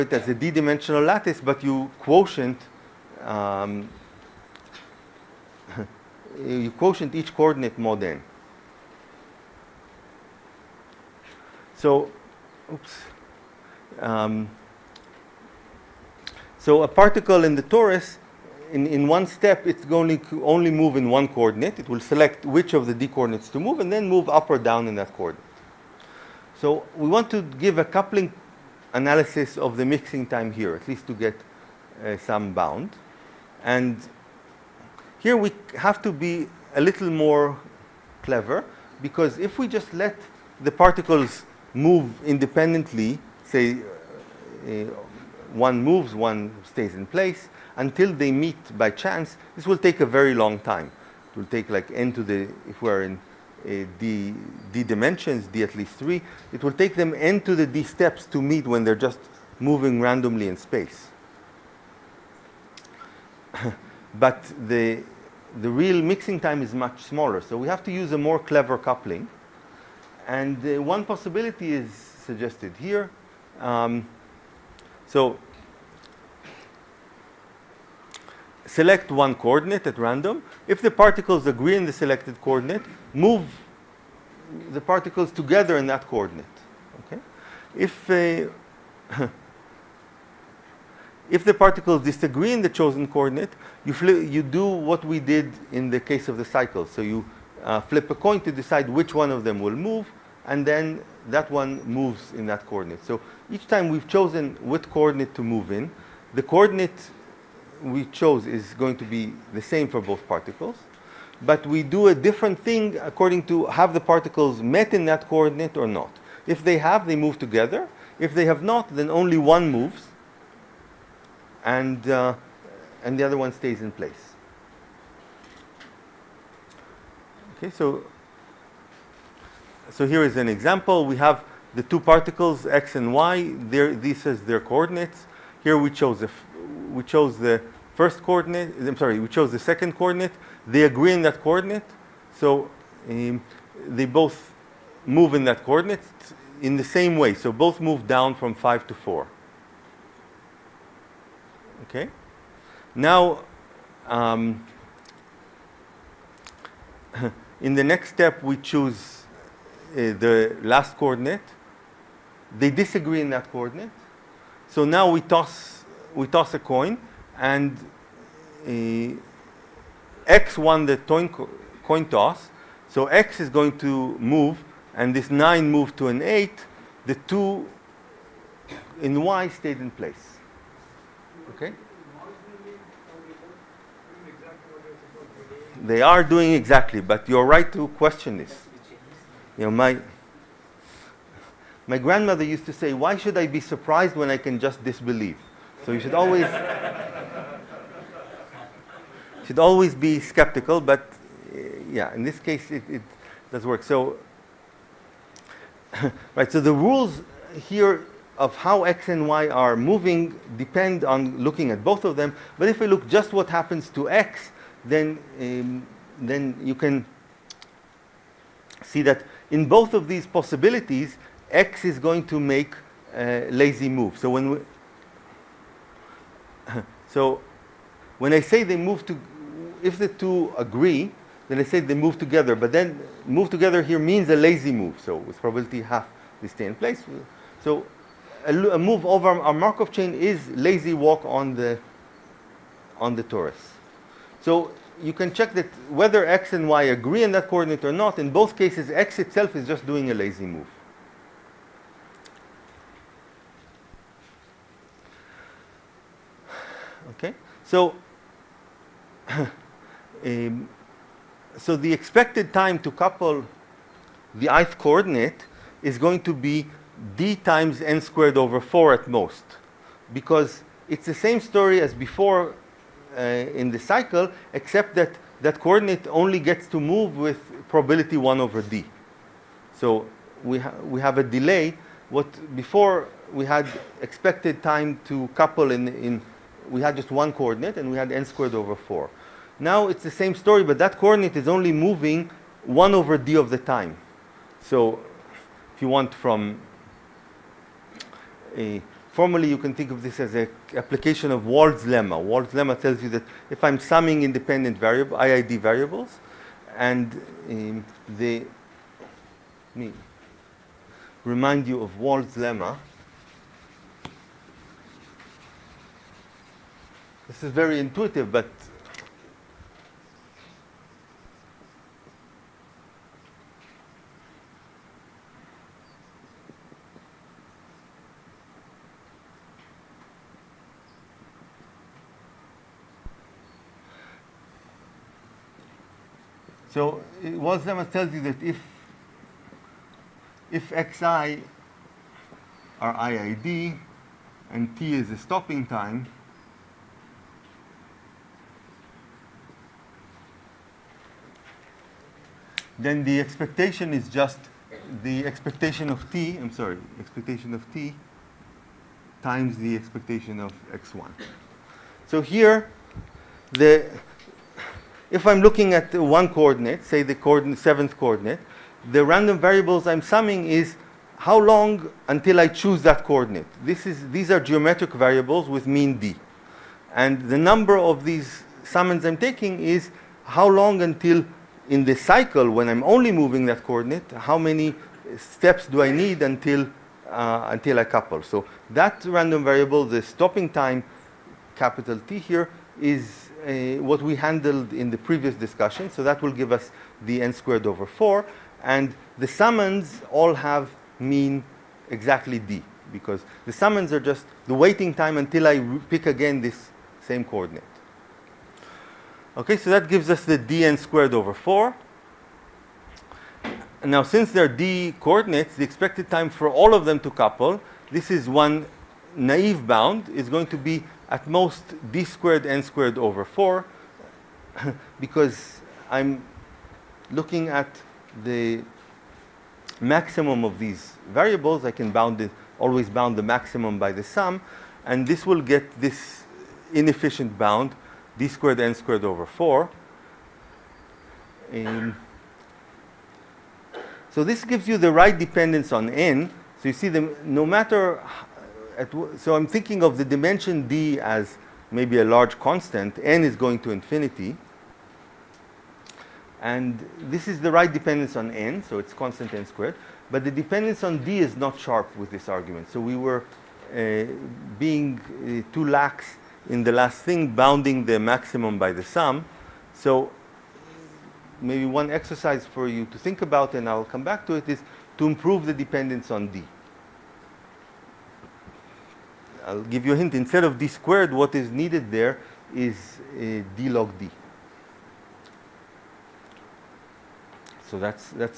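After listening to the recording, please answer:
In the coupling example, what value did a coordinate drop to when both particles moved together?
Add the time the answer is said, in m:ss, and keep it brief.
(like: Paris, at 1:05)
4, at 2:28.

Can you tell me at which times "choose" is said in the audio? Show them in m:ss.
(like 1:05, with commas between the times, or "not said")
2:38, 6:12.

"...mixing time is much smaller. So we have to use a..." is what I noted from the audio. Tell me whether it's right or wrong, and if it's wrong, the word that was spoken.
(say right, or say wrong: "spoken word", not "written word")
right.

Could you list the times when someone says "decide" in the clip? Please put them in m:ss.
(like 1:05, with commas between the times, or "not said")
1:38.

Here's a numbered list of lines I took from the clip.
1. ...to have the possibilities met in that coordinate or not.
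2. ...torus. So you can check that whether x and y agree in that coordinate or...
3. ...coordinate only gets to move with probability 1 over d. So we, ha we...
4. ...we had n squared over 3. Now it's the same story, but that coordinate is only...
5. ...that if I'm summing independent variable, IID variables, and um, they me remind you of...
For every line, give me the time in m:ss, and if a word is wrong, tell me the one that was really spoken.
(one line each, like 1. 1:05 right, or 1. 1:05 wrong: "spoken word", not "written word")
1. 1:53 wrong: "particles", not "possibilities"
2. 4:03 right
3. 4:35 right
4. 4:47 wrong: "4", not "3"
5. 5:03 right.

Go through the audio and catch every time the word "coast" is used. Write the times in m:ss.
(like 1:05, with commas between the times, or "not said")
not said.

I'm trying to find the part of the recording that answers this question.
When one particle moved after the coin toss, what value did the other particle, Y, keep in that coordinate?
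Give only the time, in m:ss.
2:57.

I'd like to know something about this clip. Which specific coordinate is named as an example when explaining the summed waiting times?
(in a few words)
Seventh.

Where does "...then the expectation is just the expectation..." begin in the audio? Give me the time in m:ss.
5:52.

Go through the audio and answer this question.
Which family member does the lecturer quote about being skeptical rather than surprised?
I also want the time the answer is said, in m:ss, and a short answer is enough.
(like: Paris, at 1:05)
Grandmother, at 3:11.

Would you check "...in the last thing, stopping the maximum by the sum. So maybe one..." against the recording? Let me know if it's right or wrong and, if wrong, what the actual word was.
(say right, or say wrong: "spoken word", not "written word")
wrong: "bounding", not "stopping".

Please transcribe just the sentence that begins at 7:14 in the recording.
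And this will get this inefficient bound, d squared n squared over 4.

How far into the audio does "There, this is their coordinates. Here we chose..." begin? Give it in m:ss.
2:13.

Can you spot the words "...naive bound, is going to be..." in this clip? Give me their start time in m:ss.
6:59.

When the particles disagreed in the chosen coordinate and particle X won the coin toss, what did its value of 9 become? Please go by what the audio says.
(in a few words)
8.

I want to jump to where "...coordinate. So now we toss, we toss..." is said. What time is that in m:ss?
2:43.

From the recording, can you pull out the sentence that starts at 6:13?
This is, these are geometric variables with mean d.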